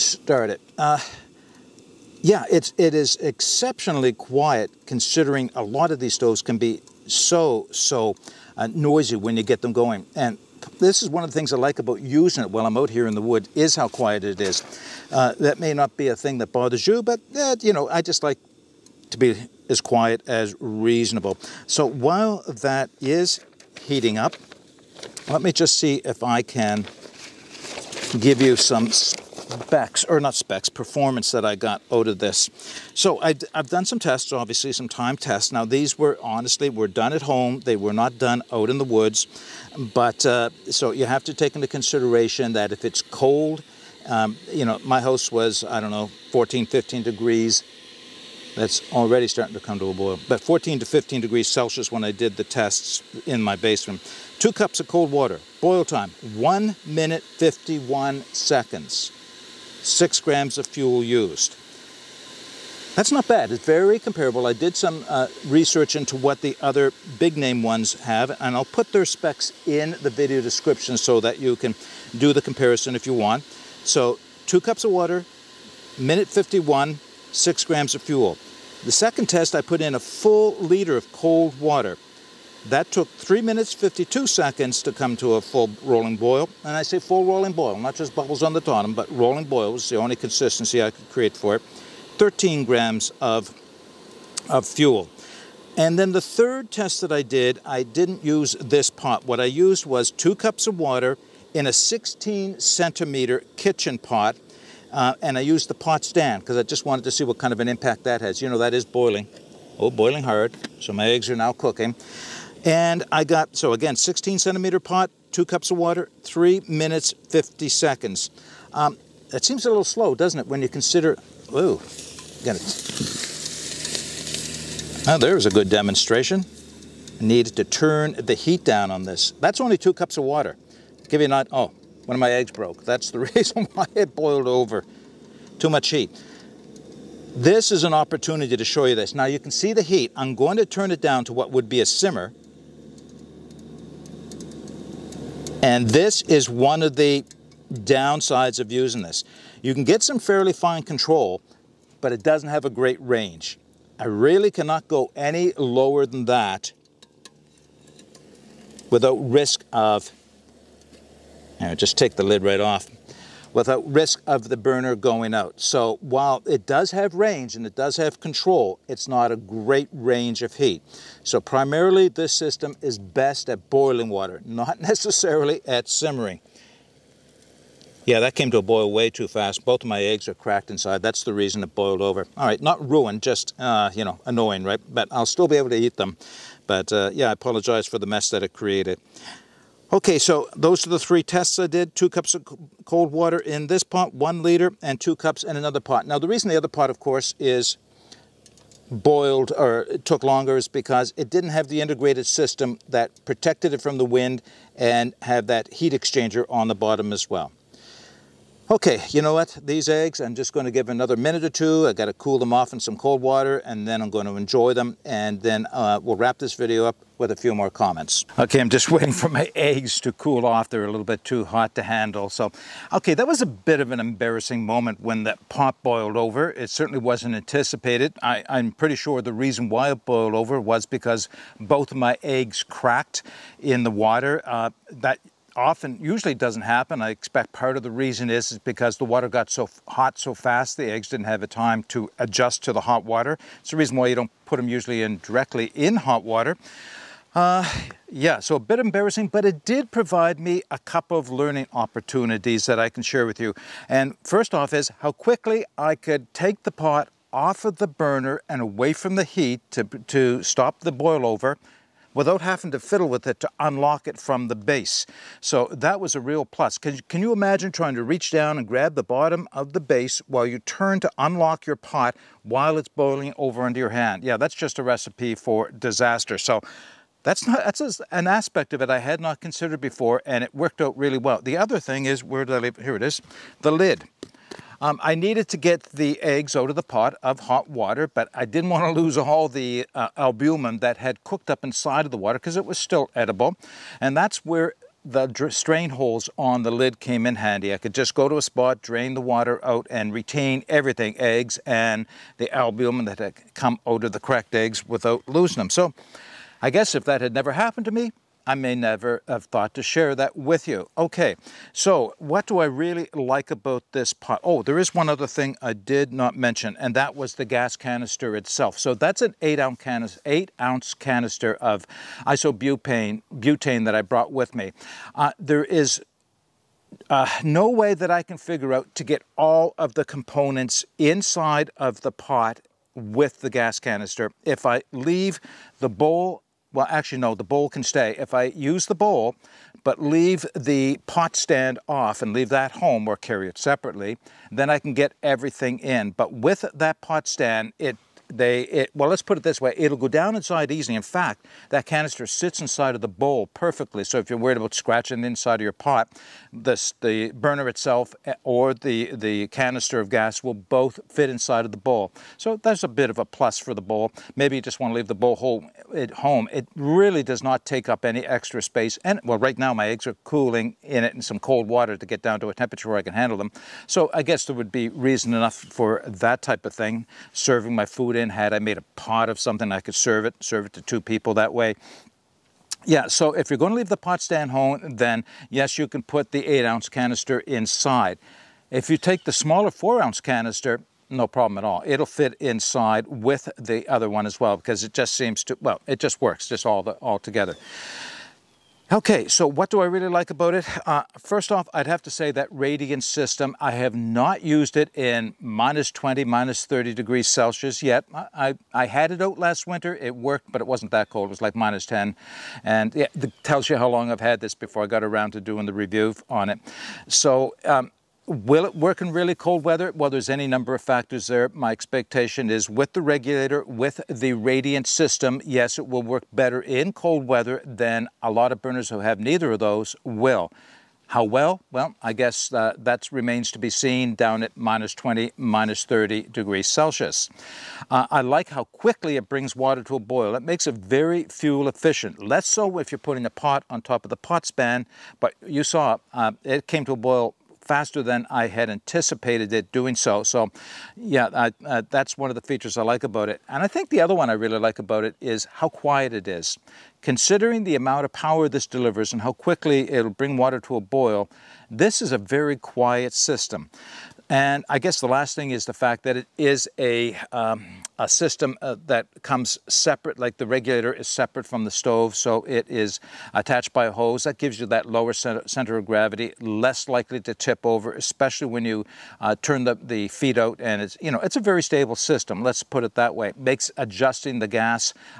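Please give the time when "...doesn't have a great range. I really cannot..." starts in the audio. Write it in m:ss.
2:32.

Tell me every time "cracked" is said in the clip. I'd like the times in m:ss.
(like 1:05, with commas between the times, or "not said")
3:00, 3:52, 5:04.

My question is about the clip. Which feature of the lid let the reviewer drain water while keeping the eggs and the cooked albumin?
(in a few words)
strain holes.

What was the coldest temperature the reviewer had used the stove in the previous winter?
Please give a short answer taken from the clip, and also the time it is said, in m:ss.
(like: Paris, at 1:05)
minus 10 degrees Celsius, at 6:51.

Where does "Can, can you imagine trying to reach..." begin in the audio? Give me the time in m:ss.
4:26.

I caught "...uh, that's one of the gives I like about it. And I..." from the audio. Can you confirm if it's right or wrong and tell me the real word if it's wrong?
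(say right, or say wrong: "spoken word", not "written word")
wrong: "features", not "gives".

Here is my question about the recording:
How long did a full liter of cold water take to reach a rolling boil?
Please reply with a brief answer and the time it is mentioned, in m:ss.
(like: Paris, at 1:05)
3 minutes 52 seconds, at 1:23.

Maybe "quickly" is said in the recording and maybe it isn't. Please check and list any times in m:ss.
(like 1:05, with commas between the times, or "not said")
4:15, 7:18, 7:39.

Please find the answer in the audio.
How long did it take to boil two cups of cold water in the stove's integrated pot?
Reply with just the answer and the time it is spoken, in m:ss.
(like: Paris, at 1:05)
1 minute 51 seconds, at 0:56.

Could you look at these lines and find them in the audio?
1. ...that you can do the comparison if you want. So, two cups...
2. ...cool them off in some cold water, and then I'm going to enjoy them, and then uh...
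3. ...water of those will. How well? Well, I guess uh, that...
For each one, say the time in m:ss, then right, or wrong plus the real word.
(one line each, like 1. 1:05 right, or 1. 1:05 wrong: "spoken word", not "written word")
1. 1:11 right
2. 3:32 right
3. 7:09 wrong: "neither", not "water".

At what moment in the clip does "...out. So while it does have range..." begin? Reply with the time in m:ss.
2:45.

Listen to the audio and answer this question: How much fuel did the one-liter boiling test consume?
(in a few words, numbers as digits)
13 grams.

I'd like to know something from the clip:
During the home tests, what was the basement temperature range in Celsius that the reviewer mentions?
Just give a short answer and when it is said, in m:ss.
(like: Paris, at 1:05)
14 to 15 degrees, at 0:50.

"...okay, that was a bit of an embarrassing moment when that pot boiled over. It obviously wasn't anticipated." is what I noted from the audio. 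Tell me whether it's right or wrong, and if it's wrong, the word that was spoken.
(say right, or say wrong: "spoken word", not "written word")
wrong: "certainly", not "obviously".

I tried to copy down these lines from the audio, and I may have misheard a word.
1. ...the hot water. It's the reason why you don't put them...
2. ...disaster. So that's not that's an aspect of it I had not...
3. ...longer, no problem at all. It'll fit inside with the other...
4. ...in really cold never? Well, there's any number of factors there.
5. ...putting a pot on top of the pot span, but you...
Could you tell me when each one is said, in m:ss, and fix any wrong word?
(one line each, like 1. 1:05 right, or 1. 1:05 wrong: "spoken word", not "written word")
1. 4:02 right
2. 4:35 right
3. 6:30 wrong: "canister", not "longer"
4. 6:58 wrong: "weather", not "never"
5. 7:22 right.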